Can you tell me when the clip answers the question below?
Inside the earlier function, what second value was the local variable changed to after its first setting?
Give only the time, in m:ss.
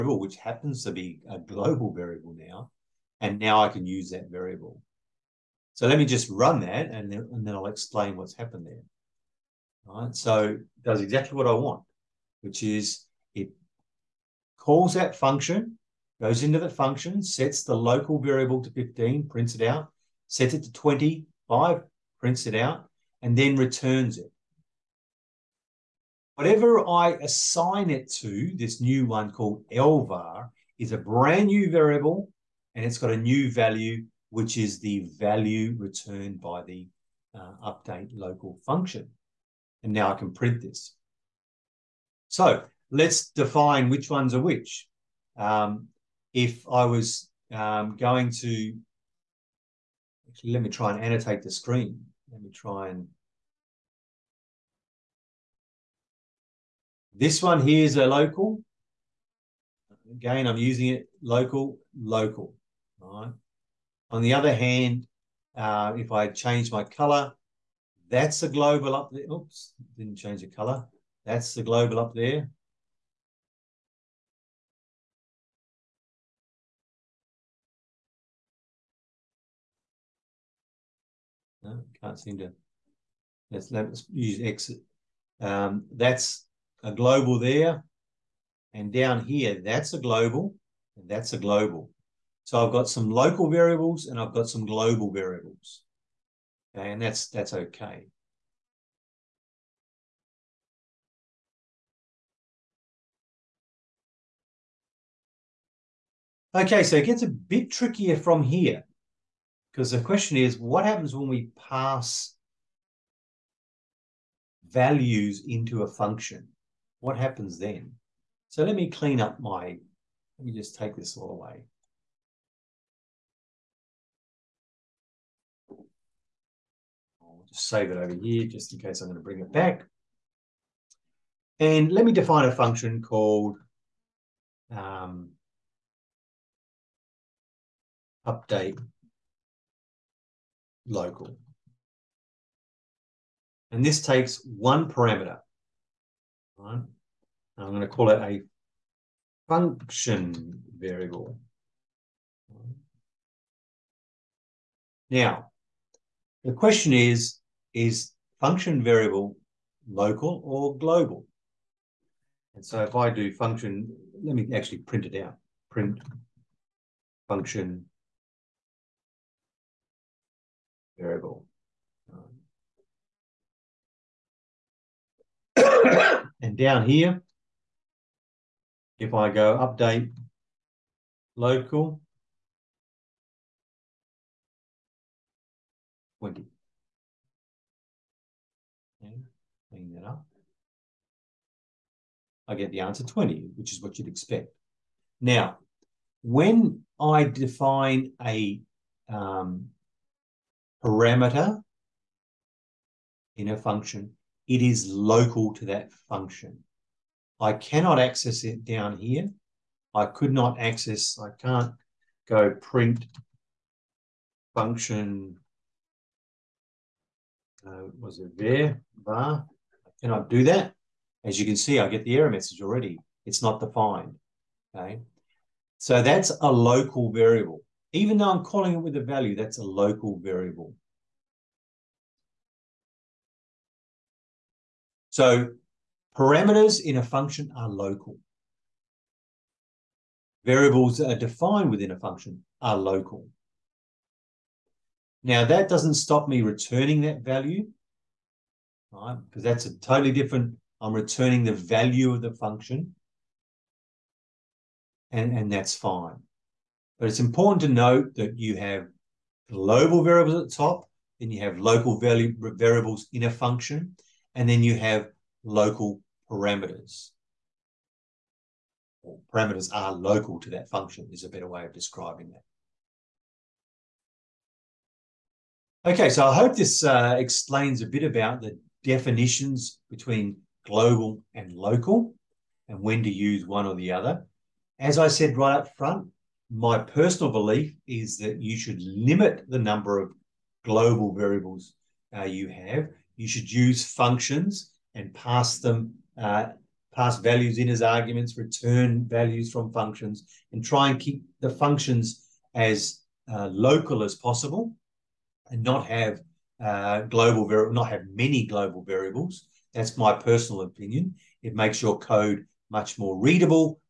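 0:20.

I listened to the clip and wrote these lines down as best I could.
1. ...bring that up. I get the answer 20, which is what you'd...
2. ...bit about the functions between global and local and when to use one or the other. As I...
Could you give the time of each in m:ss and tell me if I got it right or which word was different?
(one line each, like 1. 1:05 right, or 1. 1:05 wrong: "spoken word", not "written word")
1. 3:09 right
2. 4:37 wrong: "definitions", not "functions".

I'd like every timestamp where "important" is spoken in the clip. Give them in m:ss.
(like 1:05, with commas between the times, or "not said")
4:17.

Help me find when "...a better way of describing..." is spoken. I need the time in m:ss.
4:31.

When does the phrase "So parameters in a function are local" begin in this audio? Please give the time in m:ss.
3:55.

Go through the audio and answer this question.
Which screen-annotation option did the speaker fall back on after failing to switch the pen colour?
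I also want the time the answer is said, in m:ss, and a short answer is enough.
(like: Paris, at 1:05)
exit, at 1:24.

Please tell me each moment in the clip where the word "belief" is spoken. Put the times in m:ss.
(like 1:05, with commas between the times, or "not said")
4:47.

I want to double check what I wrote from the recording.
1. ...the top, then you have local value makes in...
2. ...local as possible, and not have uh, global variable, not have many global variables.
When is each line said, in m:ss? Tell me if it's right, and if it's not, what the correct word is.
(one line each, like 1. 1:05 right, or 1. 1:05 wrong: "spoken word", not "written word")
1. 4:20 wrong: "variables", not "makes"
2. 5:03 right.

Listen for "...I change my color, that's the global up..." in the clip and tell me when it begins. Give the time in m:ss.
1:06.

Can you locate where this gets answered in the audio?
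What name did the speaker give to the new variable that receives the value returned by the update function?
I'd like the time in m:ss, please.
0:29.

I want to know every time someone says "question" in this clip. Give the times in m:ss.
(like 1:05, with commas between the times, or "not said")
1:50, 2:36.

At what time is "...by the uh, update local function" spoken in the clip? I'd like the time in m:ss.
0:36.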